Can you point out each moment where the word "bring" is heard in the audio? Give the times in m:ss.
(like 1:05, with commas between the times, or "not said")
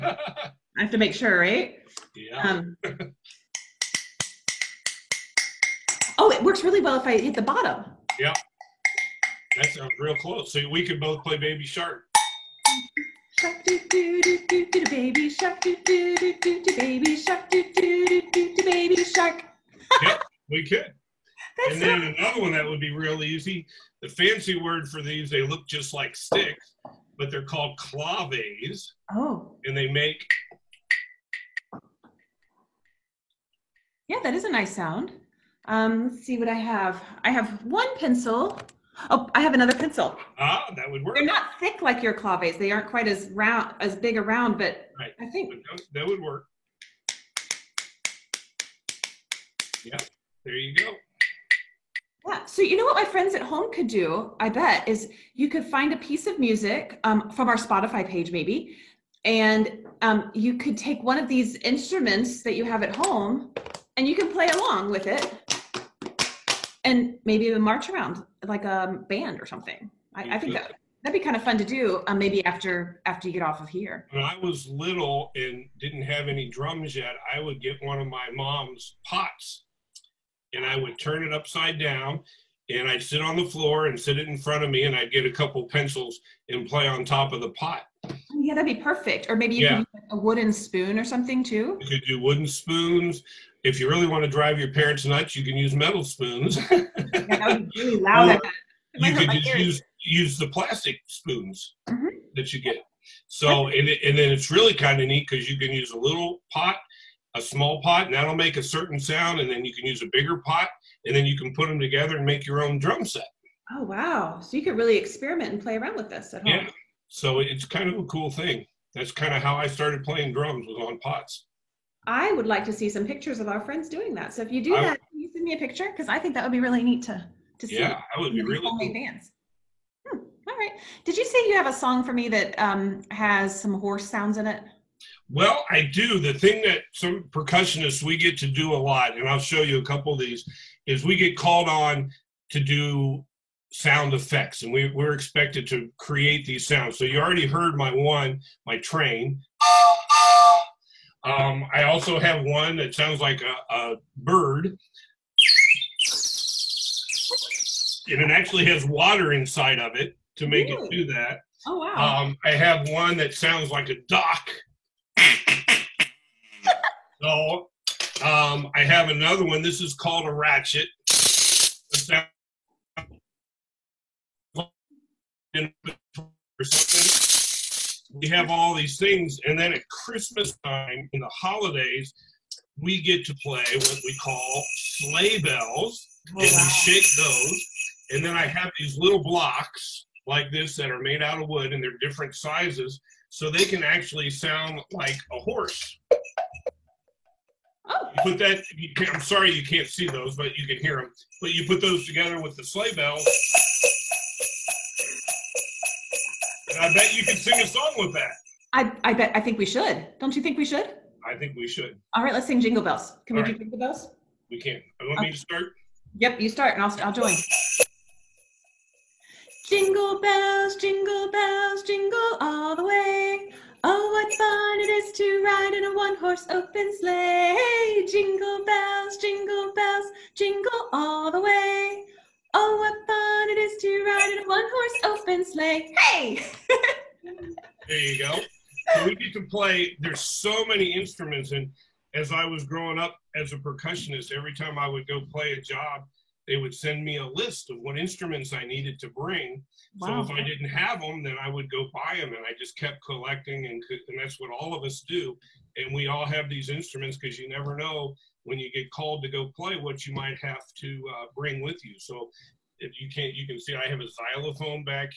4:09, 4:21.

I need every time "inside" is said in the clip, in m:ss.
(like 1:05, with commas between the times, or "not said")
2:39.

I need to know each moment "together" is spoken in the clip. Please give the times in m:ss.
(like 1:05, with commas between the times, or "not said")
1:51, 3:22.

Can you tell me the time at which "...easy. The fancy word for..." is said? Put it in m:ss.
0:23.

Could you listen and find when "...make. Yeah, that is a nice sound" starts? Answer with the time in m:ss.
0:29.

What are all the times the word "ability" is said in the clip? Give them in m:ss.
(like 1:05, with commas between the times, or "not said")
not said.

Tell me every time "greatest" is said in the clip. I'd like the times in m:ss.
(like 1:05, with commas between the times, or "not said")
not said.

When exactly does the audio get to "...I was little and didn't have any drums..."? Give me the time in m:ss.
1:14.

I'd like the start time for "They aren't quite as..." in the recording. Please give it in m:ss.
0:42.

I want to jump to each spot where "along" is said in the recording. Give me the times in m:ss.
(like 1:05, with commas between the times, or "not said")
1:04.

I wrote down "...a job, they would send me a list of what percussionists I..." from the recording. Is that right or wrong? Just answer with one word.
wrong.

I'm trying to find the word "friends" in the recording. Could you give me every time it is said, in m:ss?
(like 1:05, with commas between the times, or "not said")
0:53, 2:03.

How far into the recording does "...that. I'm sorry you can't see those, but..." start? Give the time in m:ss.
3:18.